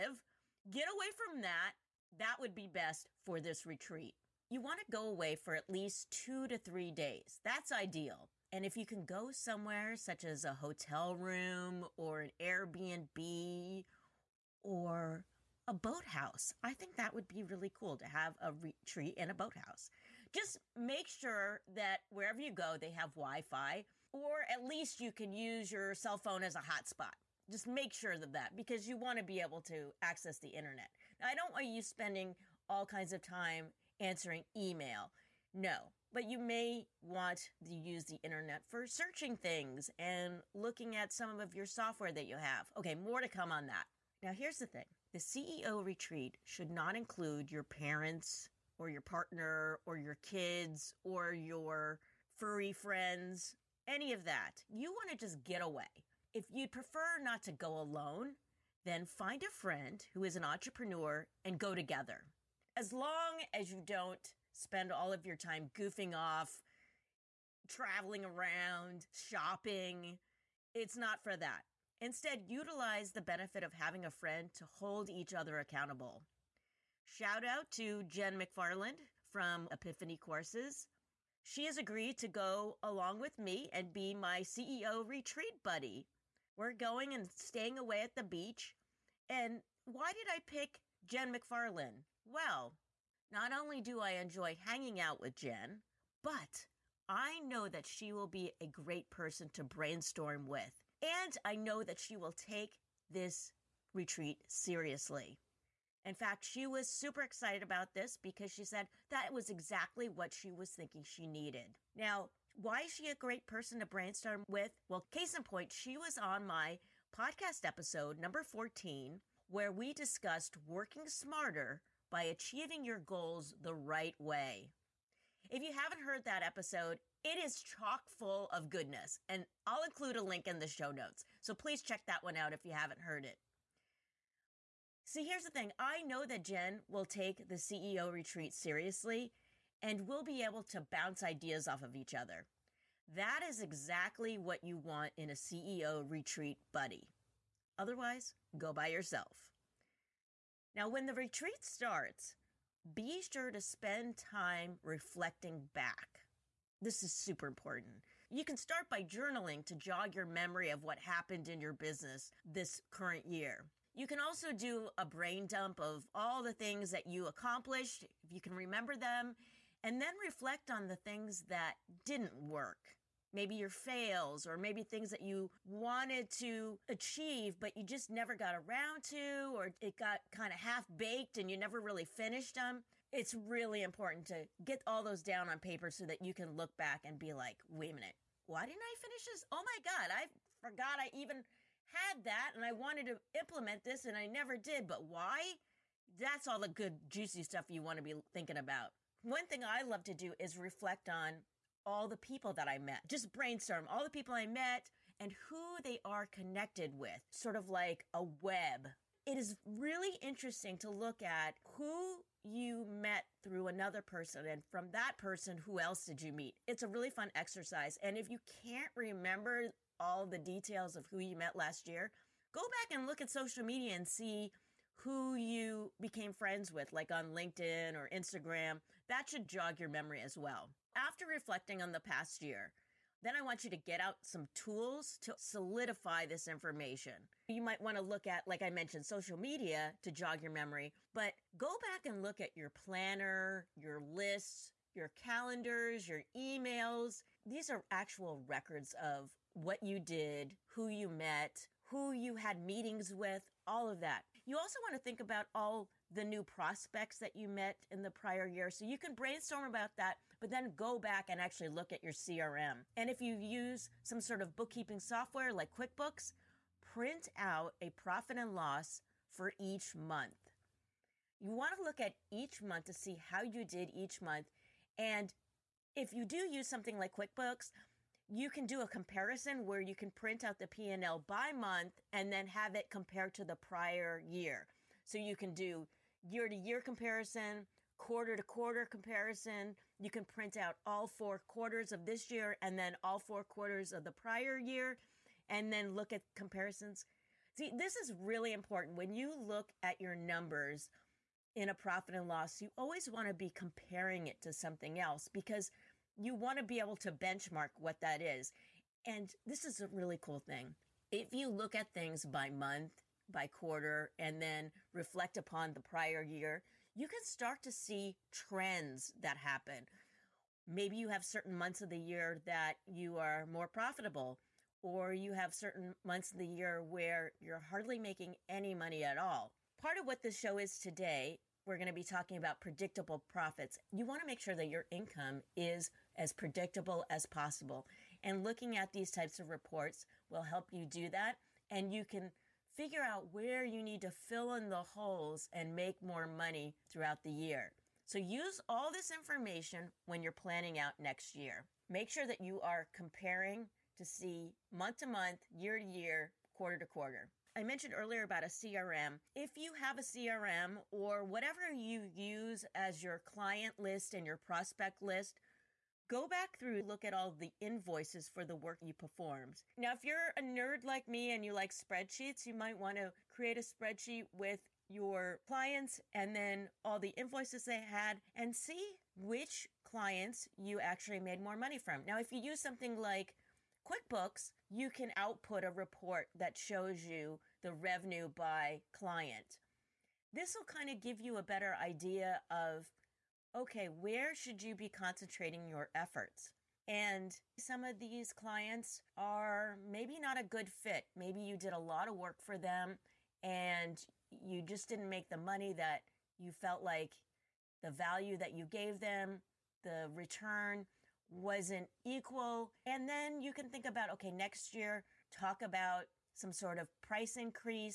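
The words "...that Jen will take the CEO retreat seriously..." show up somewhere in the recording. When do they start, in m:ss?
2:16.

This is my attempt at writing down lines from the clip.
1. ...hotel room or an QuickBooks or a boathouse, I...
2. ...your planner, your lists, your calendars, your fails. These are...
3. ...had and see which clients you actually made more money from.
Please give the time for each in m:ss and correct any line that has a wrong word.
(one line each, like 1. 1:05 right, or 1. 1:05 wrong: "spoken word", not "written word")
1. 0:10 wrong: "Airbnb", not "QuickBooks"
2. 4:02 wrong: "emails", not "fails"
3. 6:17 right.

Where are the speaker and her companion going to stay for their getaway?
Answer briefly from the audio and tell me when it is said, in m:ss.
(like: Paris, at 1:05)
The beach, at 1:28.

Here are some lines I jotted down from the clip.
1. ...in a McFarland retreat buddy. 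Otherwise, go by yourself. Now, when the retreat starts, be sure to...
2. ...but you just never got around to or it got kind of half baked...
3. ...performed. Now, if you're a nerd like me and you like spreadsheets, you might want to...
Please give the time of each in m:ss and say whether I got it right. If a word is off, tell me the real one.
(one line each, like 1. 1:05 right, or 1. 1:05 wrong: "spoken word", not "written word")
1. 2:25 wrong: "CEO", not "McFarland"
2. 2:57 right
3. 6:08 right.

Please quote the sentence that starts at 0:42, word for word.
Okay, more to come on that.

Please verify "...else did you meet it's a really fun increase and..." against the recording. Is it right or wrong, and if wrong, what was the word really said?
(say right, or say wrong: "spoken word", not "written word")
wrong: "exercise", not "increase".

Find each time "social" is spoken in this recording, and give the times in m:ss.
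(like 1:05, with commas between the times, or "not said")
3:43, 3:59.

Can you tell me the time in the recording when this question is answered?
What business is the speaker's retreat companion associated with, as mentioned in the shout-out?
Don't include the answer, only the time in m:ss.
1:19.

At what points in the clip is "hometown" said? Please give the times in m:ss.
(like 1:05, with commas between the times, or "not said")
not said.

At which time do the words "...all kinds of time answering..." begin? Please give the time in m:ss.
0:32.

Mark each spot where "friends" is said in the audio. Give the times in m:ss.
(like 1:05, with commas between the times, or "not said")
0:52, 0:59, 1:14, 3:46.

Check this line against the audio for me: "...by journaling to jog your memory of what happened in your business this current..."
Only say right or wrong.
right.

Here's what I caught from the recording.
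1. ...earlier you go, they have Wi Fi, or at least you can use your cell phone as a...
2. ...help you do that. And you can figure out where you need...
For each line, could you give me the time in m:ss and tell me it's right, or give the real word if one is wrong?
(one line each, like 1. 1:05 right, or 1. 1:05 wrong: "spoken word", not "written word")
1. 0:22 wrong: "wherever", not "earlier"
2. 5:40 right.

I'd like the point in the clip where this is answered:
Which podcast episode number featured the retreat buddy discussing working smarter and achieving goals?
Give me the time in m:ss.
1:57.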